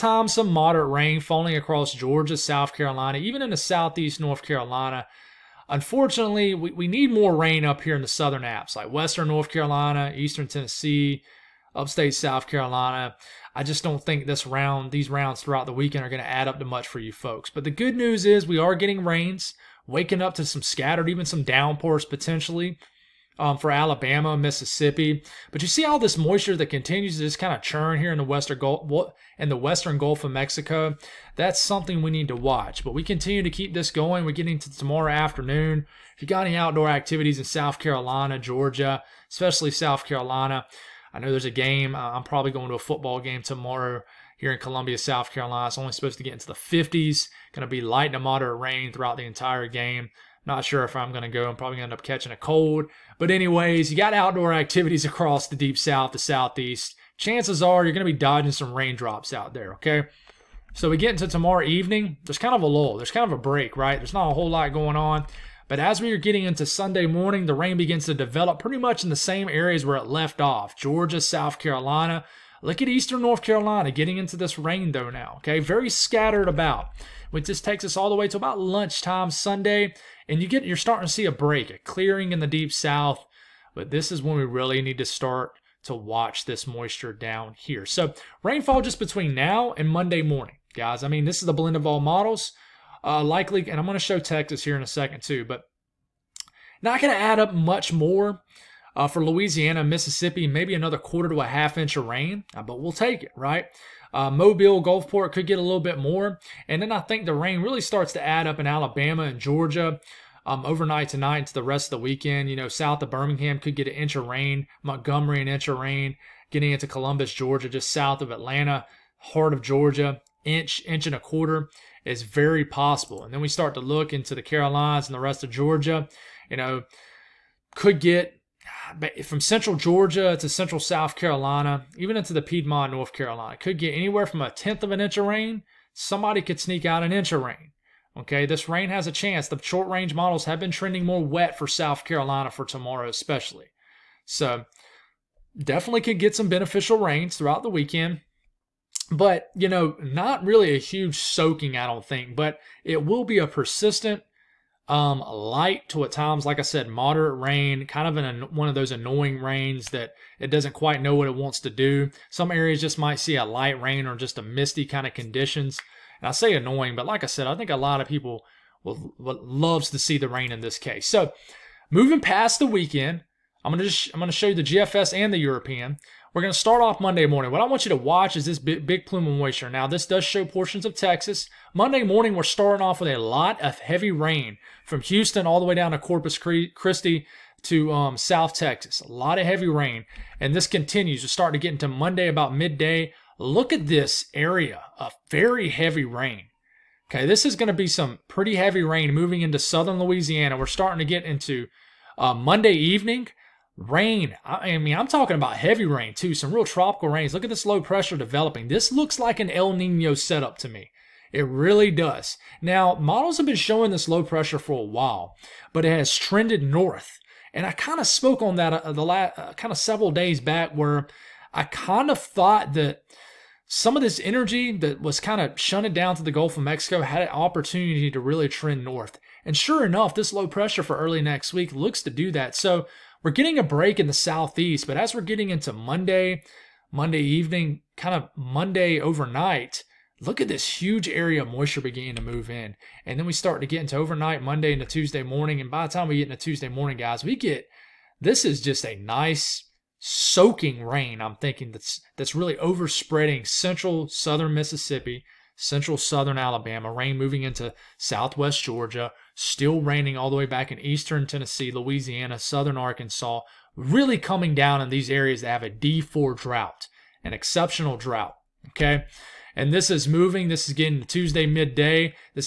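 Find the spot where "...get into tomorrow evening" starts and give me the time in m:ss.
1:00.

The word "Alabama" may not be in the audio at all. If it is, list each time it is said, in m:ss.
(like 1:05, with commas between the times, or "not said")
0:23, 1:48, 4:16.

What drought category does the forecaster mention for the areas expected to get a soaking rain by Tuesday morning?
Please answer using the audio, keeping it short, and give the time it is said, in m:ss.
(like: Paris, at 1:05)
D4, at 4:25.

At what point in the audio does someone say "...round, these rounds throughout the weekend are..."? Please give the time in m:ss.
0:14.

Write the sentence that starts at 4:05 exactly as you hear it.
And by the time we get into Tuesday morning, guys, we get this is just a nice soaking rain.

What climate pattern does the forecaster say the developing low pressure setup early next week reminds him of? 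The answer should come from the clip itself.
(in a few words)
El Nino.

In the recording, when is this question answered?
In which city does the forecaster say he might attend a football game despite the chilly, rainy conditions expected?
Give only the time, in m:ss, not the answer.
0:44.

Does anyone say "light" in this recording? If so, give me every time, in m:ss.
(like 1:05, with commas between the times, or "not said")
0:47, 2:35, 2:43.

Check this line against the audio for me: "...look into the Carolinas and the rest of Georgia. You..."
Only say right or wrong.
right.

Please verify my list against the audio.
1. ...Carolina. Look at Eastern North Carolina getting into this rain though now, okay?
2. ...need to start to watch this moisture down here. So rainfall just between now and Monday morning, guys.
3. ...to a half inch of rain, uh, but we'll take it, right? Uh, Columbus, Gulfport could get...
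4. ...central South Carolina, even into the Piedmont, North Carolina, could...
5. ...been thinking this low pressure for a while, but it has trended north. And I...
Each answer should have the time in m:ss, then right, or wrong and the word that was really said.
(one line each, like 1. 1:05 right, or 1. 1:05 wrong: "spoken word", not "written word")
1. 1:11 right
2. 1:24 right
3. 1:41 wrong: "Mobile", not "Columbus"
4. 2:10 right
5. 3:33 wrong: "showing", not "thinking".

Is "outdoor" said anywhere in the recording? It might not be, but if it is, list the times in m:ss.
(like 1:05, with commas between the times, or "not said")
0:36, 0:54.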